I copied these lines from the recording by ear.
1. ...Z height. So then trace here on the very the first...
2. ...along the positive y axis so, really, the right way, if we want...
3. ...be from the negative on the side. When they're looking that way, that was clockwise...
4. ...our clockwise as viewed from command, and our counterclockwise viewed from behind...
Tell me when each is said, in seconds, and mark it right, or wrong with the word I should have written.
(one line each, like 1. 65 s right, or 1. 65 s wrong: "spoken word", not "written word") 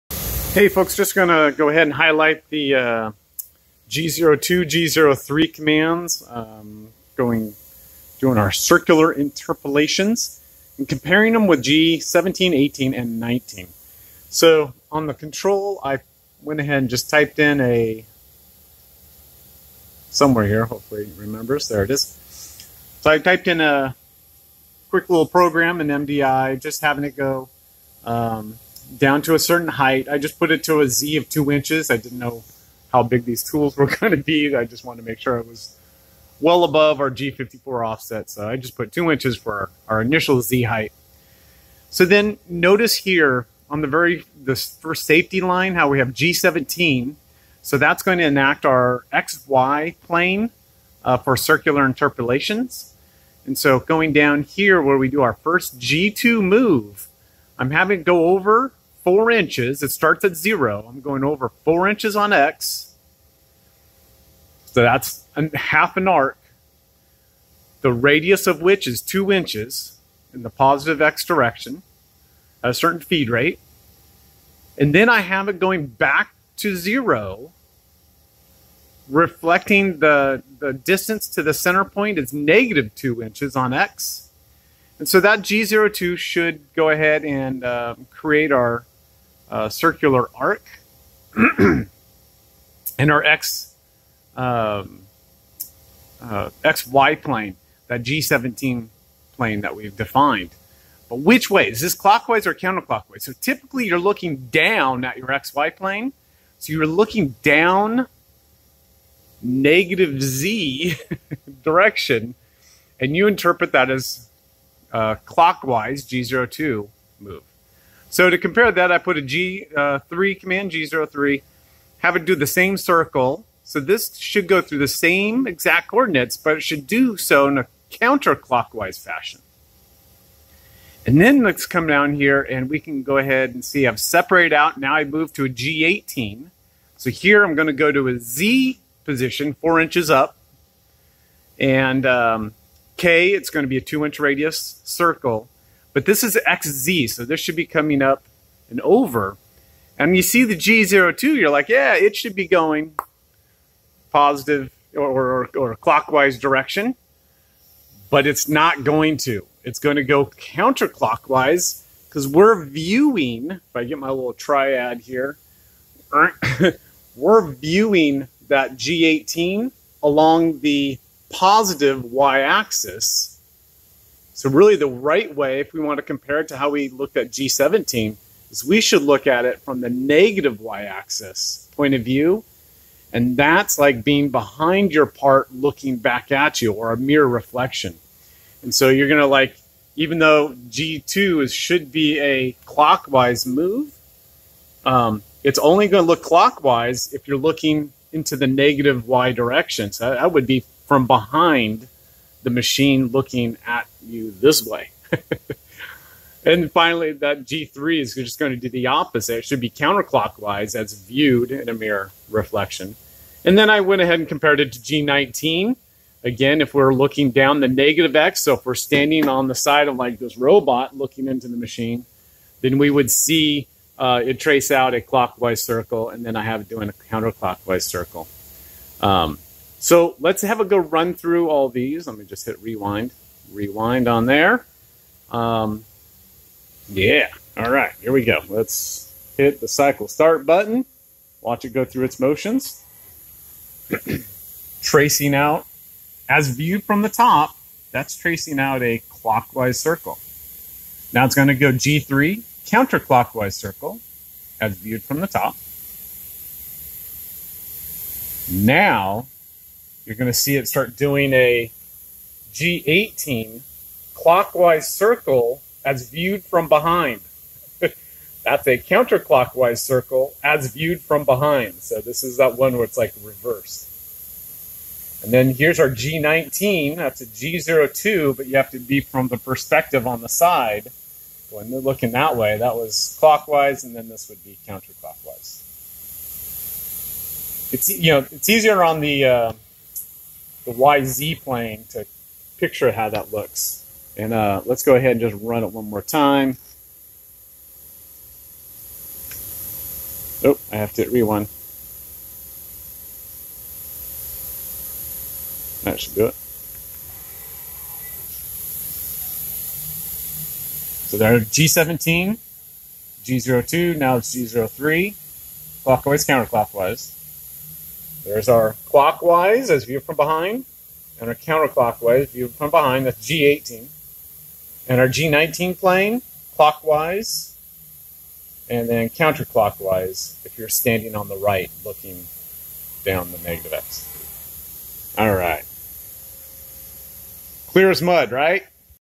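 1. 40 s wrong: "notice", not "trace"
2. 170 s right
3. 278 s wrong: "perspective", not "negative"
4. 318 s wrong: "behind", not "command".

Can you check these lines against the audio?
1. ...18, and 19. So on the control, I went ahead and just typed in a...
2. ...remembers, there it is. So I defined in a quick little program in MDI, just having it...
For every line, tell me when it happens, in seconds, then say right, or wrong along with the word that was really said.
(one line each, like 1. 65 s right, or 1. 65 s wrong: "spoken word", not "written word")
1. 12 s right
2. 21 s wrong: "typed", not "defined".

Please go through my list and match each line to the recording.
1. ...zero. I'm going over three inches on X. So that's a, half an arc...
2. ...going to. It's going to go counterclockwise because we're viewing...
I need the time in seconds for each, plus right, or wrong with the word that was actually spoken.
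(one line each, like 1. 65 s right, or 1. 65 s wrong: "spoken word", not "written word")
1. 60 s wrong: "four", not "three"
2. 158 s right.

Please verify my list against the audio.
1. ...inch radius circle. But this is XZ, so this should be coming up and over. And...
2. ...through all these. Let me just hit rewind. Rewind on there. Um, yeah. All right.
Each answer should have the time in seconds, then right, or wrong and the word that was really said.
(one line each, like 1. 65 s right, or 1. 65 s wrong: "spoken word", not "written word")
1. 144 s right
2. 231 s right.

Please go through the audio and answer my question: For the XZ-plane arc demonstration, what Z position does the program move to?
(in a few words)
4 inches.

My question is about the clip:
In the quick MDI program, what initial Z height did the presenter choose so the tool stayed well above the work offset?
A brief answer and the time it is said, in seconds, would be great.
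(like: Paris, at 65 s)
2 inches, at 30 s.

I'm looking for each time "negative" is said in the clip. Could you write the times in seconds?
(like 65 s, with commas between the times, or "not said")
82 s, 109 s, 179 s, 198 s, 217 s, 333 s.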